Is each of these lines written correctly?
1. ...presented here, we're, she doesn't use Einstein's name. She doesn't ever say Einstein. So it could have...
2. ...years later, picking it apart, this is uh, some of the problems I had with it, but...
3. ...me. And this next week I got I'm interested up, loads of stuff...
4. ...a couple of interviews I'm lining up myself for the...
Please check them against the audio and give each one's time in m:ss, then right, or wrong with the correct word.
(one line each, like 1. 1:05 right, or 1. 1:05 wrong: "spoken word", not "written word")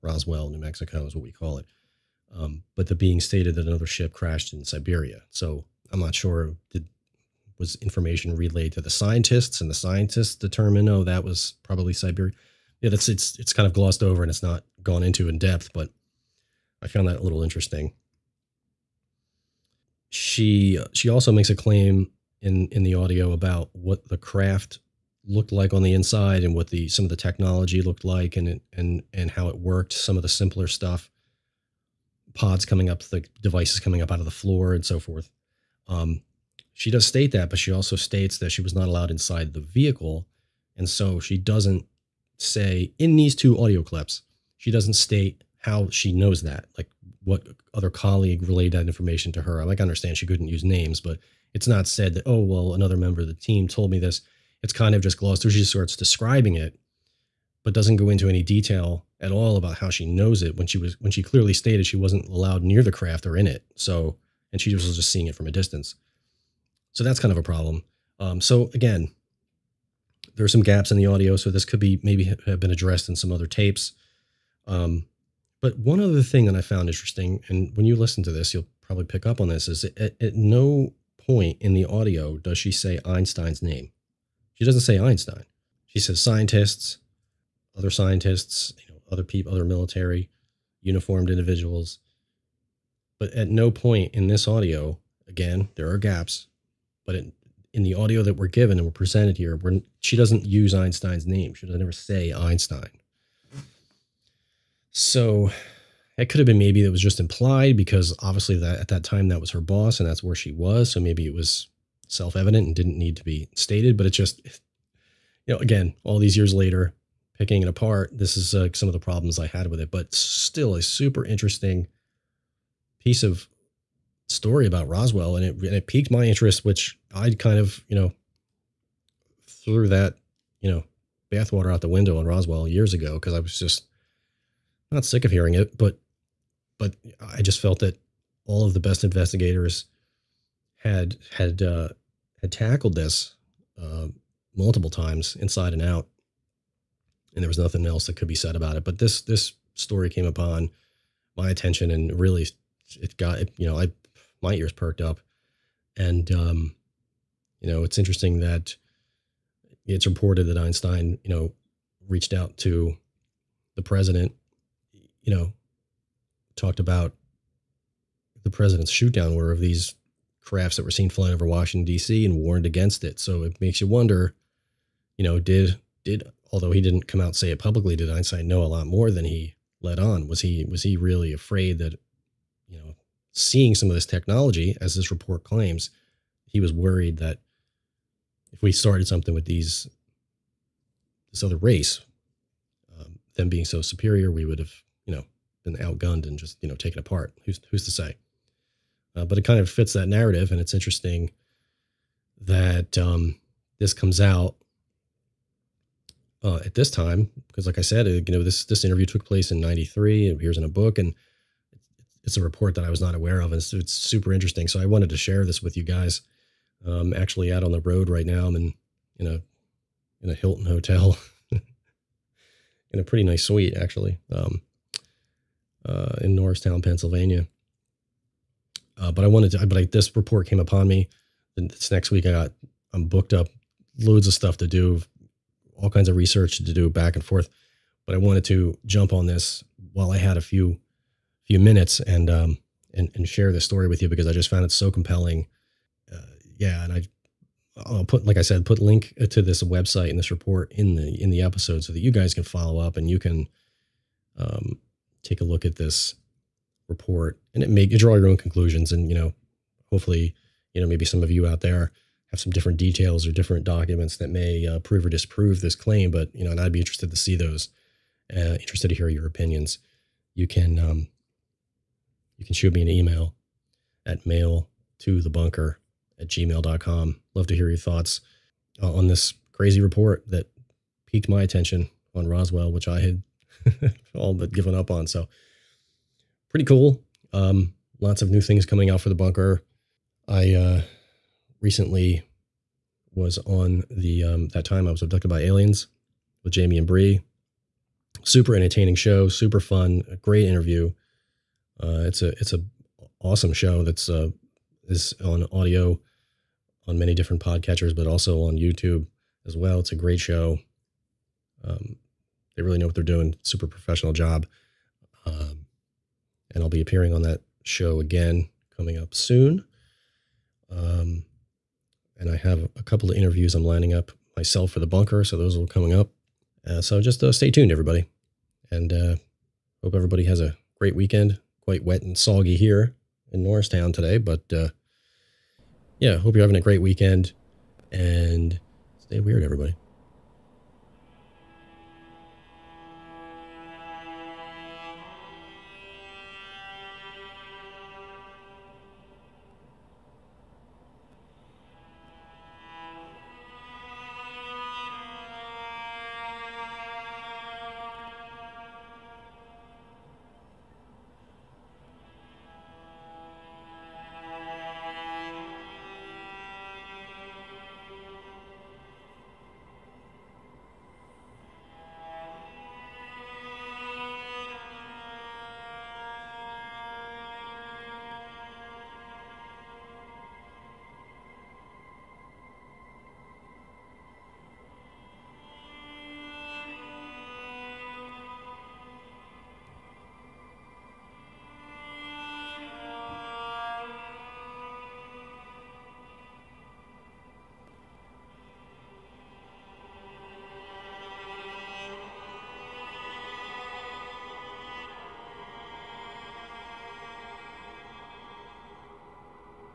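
1. 1:38 right
2. 1:56 right
3. 3:50 wrong: "booked", not "interested"
4. 5:22 right.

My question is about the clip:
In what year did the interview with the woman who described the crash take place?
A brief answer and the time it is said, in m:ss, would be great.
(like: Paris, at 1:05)
1993, at 3:29.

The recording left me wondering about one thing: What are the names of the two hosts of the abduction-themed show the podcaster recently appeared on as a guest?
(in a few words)
Jamie and Bree.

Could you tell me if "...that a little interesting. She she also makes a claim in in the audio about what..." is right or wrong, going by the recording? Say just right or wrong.
right.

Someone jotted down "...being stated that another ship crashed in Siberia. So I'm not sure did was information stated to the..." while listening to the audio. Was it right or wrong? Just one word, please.
wrong.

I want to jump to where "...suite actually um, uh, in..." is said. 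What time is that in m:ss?
3:43.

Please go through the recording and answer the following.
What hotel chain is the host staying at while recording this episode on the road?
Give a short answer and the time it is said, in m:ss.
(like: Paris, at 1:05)
Hilton, at 3:40.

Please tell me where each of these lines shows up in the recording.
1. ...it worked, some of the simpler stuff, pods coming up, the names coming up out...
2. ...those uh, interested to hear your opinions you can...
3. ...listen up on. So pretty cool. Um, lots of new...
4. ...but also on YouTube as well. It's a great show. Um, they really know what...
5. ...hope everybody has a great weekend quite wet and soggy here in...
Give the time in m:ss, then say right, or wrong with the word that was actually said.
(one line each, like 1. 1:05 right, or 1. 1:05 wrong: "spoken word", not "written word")
1. 0:29 wrong: "devices", not "names"
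2. 4:27 right
3. 4:44 wrong: "given", not "listen"
4. 5:07 right
5. 5:29 right.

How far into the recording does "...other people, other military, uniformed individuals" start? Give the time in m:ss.
1:29.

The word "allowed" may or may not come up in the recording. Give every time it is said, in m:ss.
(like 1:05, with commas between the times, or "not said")
0:38, 1:02.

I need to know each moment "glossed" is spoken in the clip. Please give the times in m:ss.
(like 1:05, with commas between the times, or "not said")
0:13, 0:55.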